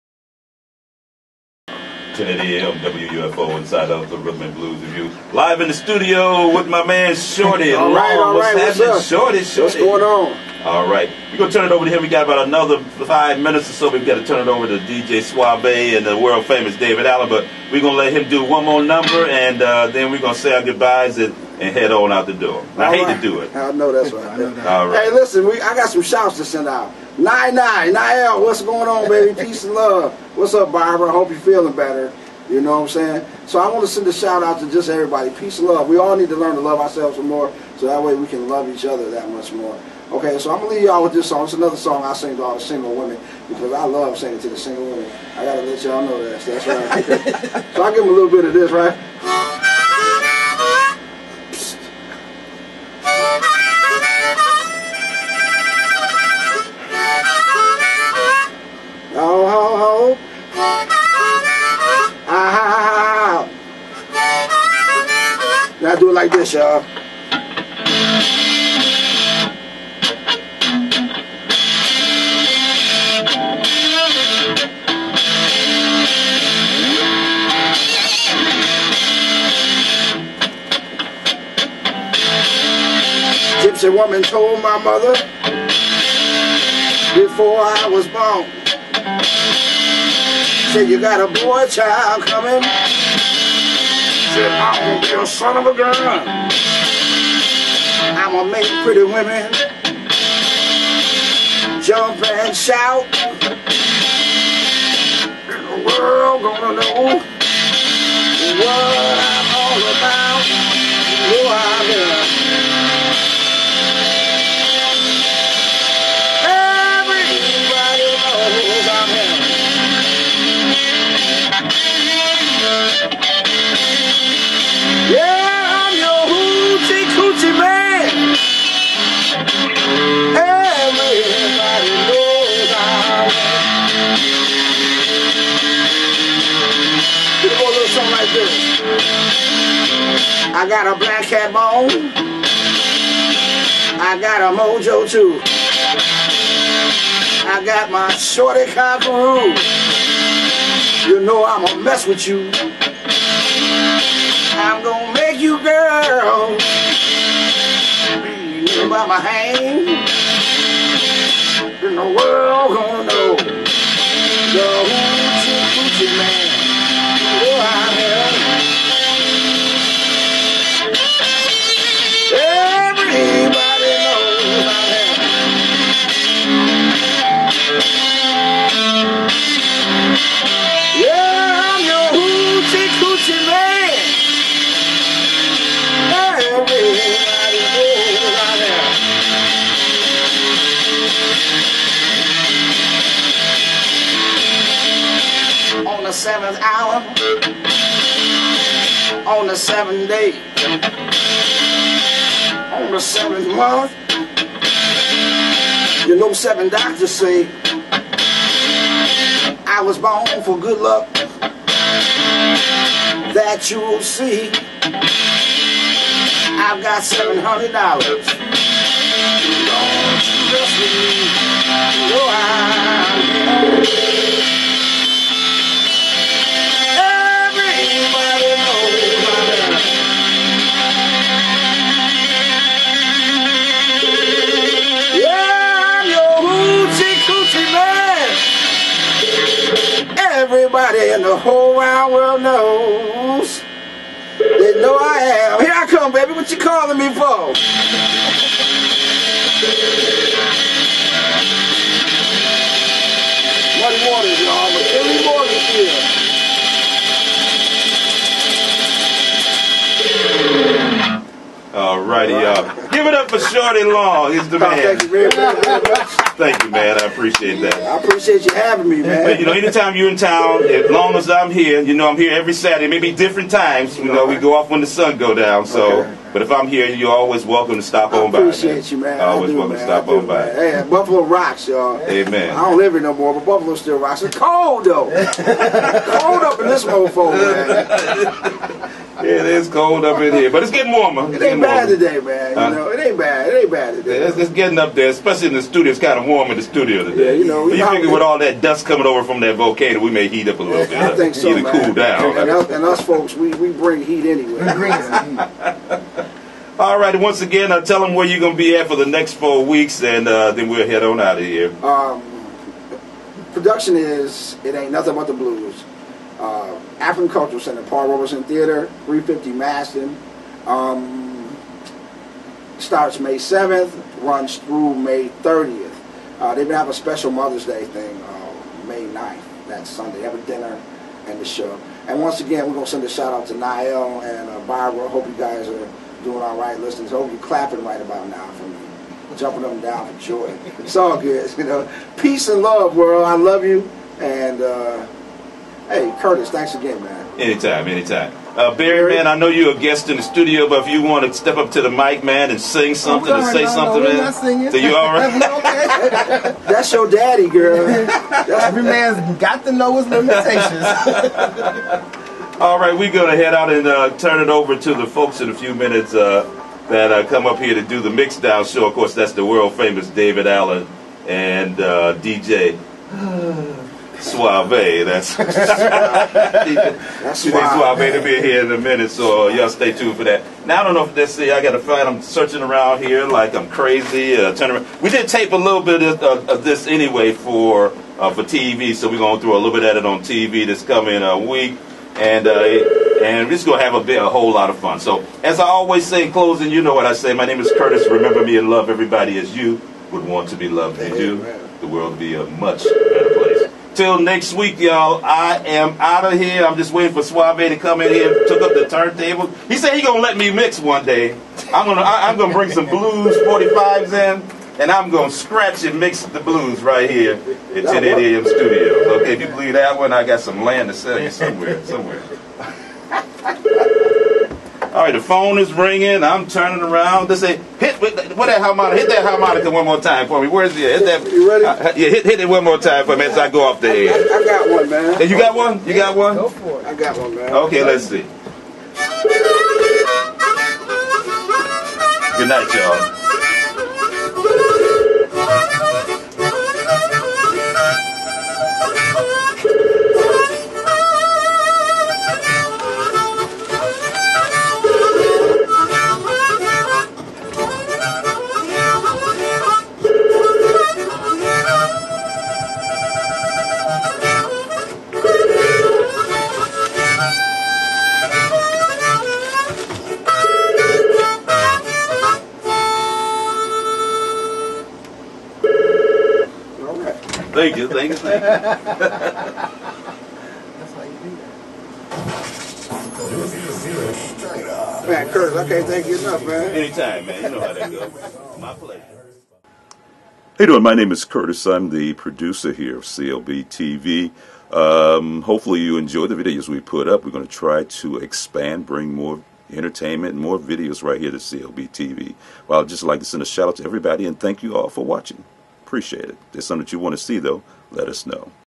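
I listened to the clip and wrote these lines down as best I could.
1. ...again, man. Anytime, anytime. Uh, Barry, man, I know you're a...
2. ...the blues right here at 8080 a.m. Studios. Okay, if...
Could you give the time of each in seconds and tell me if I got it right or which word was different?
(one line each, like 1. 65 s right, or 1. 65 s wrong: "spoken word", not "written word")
1. 346 s right
2. 416 s wrong: "1080", not "8080".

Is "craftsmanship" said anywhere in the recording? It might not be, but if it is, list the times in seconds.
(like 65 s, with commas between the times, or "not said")
not said.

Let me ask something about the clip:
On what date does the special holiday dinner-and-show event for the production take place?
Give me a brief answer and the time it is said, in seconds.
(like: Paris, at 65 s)
May 9th, at 328 s.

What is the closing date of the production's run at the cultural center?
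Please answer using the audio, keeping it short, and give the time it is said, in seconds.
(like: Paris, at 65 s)
May 30th, at 324 s.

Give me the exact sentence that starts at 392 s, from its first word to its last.
Uh, and we're just gonna have a bit, a whole lot of fun.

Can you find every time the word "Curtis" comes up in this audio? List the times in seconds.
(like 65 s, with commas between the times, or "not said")
346 s, 397 s, 485 s, 491 s.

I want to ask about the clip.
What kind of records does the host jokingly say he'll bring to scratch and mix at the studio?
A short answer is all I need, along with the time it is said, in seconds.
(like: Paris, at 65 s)
Blues 45s, at 412 s.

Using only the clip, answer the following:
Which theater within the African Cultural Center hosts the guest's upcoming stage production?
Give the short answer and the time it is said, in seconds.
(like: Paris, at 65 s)
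Paul Robeson Theater, at 317 s.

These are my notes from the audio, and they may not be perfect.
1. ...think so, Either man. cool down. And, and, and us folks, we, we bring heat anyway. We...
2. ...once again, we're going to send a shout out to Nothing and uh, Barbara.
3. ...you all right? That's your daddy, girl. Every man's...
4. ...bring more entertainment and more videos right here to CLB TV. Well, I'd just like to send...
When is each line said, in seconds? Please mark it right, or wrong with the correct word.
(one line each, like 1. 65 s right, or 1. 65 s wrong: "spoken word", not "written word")
1. 301 s right
2. 332 s wrong: "Niall", not "Nothing"
3. 354 s right
4. 498 s right.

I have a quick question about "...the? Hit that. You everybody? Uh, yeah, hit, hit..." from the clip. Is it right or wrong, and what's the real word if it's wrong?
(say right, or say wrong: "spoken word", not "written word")
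wrong: "ready", not "everybody".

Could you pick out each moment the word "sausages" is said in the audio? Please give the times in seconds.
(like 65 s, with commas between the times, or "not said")
not said.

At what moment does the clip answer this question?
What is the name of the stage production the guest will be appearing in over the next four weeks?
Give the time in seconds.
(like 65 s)
314 s.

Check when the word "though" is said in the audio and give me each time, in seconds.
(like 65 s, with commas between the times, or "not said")
284 s, 507 s.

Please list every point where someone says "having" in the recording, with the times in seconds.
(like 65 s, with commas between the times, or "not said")
268 s.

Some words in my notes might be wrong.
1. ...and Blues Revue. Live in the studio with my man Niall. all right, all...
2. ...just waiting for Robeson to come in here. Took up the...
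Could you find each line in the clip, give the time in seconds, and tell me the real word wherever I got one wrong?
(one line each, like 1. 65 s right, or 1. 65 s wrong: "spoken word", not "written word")
1. 4 s wrong: "Shorty", not "Niall"
2. 406 s wrong: "Suave", not "Robeson".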